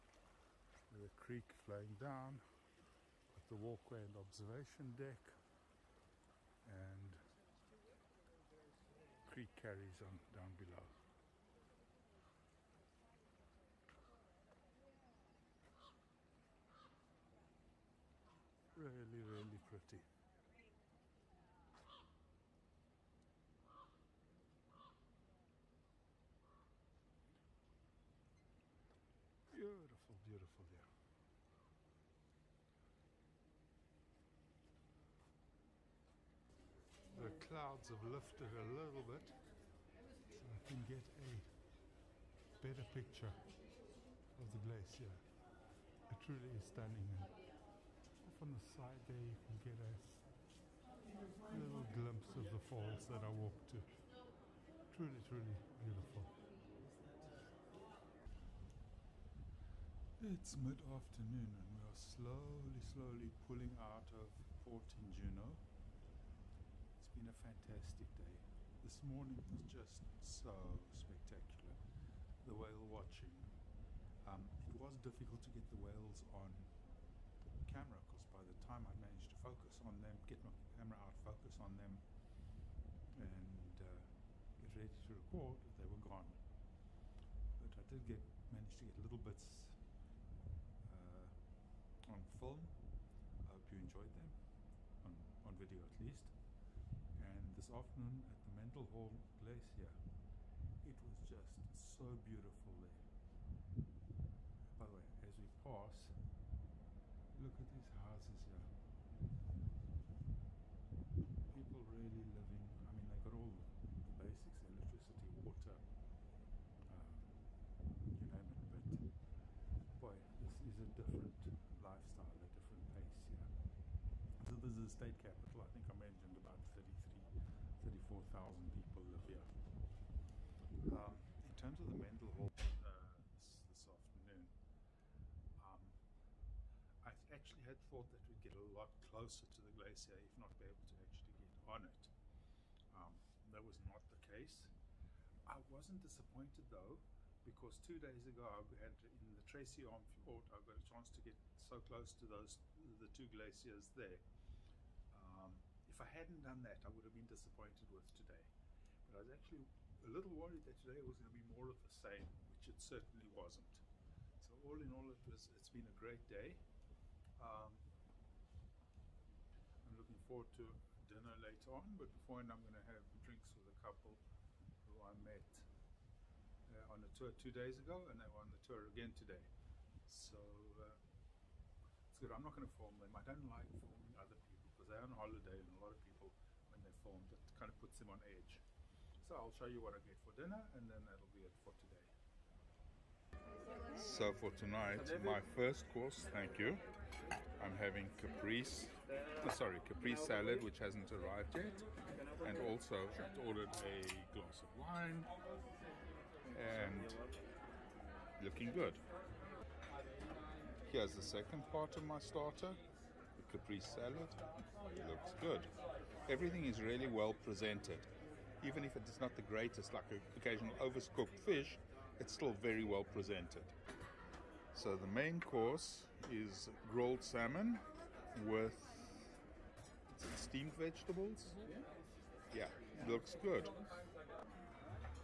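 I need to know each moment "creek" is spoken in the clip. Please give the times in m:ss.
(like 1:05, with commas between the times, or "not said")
0:01, 0:09.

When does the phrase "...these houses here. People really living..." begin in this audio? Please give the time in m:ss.
1:47.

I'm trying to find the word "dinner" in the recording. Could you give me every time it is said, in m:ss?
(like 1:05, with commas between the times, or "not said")
2:51, 3:10.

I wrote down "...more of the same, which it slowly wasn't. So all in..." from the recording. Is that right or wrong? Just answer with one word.
wrong.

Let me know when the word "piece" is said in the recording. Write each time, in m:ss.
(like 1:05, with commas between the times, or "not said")
not said.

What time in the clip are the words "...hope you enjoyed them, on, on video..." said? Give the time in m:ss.
1:33.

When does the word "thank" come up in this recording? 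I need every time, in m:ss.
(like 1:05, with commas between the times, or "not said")
3:16.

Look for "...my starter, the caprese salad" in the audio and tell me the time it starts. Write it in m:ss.
3:32.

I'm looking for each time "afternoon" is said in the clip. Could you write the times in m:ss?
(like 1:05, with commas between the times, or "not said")
1:00, 1:37, 2:13.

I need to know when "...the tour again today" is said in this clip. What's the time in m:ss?
2:58.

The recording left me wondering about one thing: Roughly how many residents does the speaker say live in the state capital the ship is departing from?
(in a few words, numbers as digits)
34,000.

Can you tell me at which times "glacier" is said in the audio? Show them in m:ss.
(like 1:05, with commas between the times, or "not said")
0:44, 2:19, 2:33.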